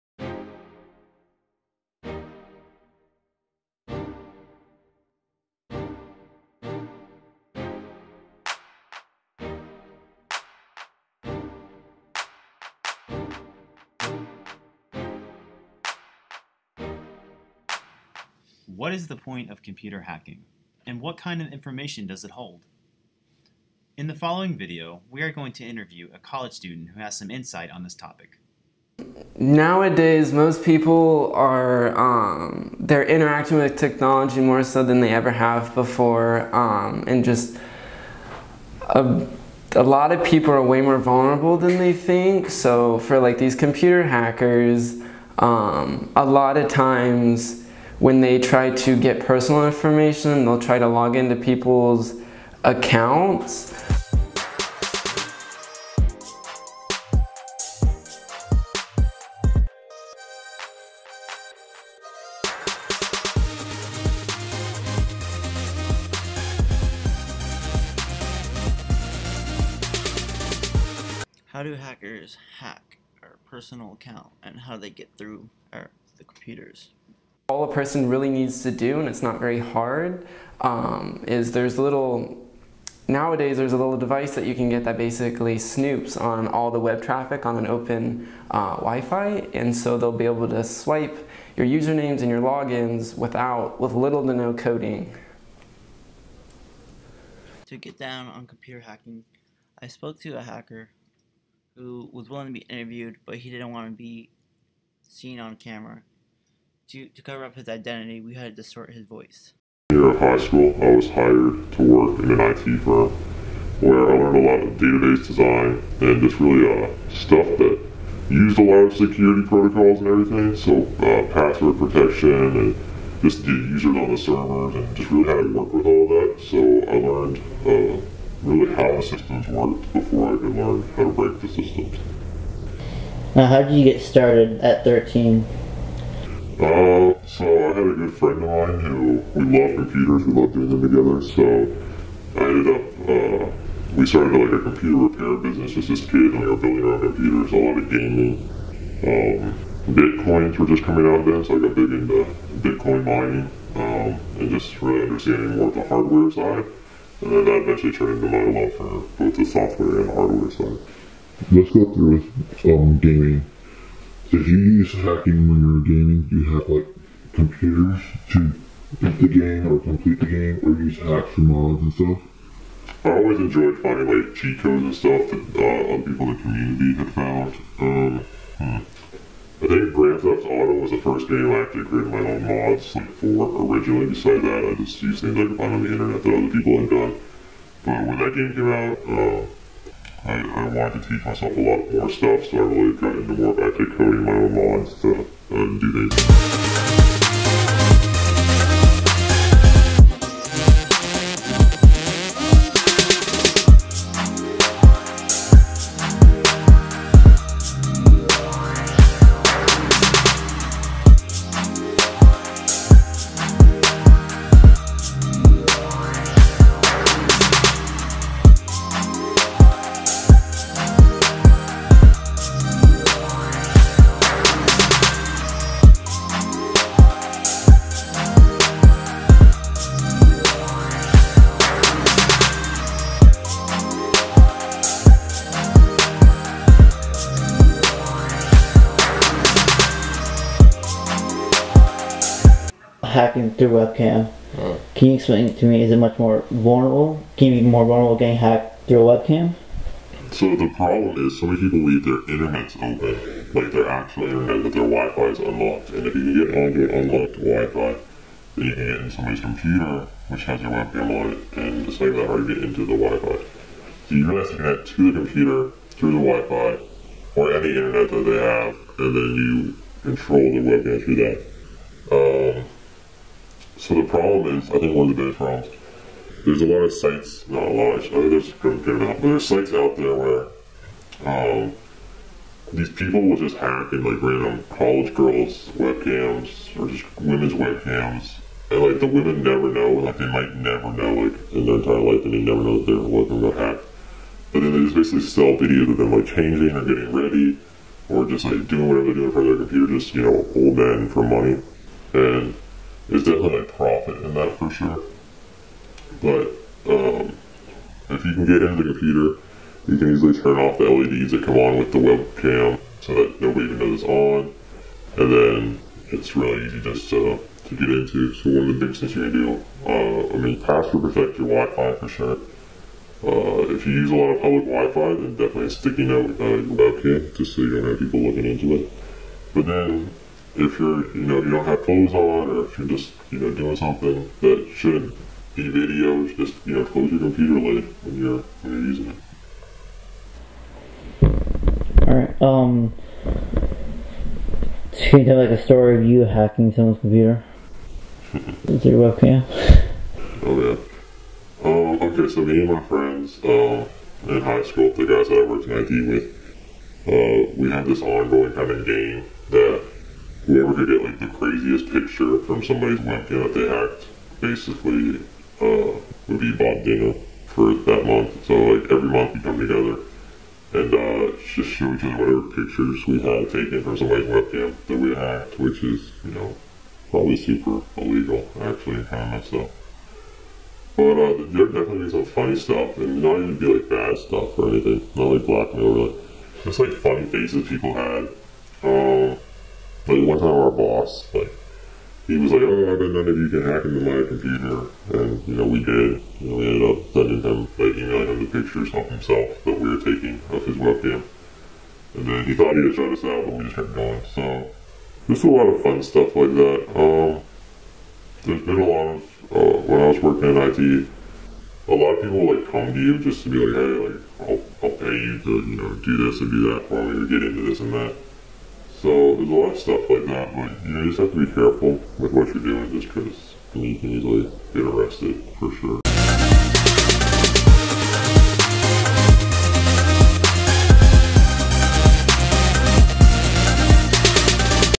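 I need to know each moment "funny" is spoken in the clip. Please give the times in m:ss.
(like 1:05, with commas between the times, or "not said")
6:22, 6:26.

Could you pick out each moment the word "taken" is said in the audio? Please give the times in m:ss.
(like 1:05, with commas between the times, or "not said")
6:13.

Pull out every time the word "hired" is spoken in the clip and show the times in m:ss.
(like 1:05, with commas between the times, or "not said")
1:51.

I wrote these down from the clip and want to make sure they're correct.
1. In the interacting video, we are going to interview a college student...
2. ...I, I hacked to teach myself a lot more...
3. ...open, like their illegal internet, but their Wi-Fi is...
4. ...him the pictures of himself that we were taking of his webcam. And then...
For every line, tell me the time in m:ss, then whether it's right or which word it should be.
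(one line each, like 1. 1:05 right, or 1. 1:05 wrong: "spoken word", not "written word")
1. 0:23 wrong: "following", not "interacting"
2. 3:10 wrong: "wanted", not "hacked"
3. 4:12 wrong: "actual", not "illegal"
4. 6:38 right.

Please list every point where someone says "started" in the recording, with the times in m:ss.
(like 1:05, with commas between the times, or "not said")
2:14, 2:24.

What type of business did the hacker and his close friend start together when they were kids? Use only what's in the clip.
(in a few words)
computer repair business.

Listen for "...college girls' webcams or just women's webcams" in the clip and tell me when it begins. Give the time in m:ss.
4:44.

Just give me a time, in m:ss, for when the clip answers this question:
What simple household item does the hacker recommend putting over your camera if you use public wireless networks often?
5:25.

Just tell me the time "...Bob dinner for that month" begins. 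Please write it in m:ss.
6:06.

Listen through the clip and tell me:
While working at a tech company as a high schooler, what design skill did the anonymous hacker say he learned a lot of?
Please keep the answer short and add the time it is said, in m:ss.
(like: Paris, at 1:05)
database design, at 1:54.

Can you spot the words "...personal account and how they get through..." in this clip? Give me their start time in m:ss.
1:13.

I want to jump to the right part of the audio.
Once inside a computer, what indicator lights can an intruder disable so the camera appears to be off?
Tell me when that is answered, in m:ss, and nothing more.
5:10.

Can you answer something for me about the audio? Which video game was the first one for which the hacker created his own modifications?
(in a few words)
Grand Theft Auto.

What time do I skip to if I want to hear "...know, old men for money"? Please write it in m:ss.
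5:00.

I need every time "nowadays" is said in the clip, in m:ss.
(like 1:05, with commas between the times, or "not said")
0:29, 1:23.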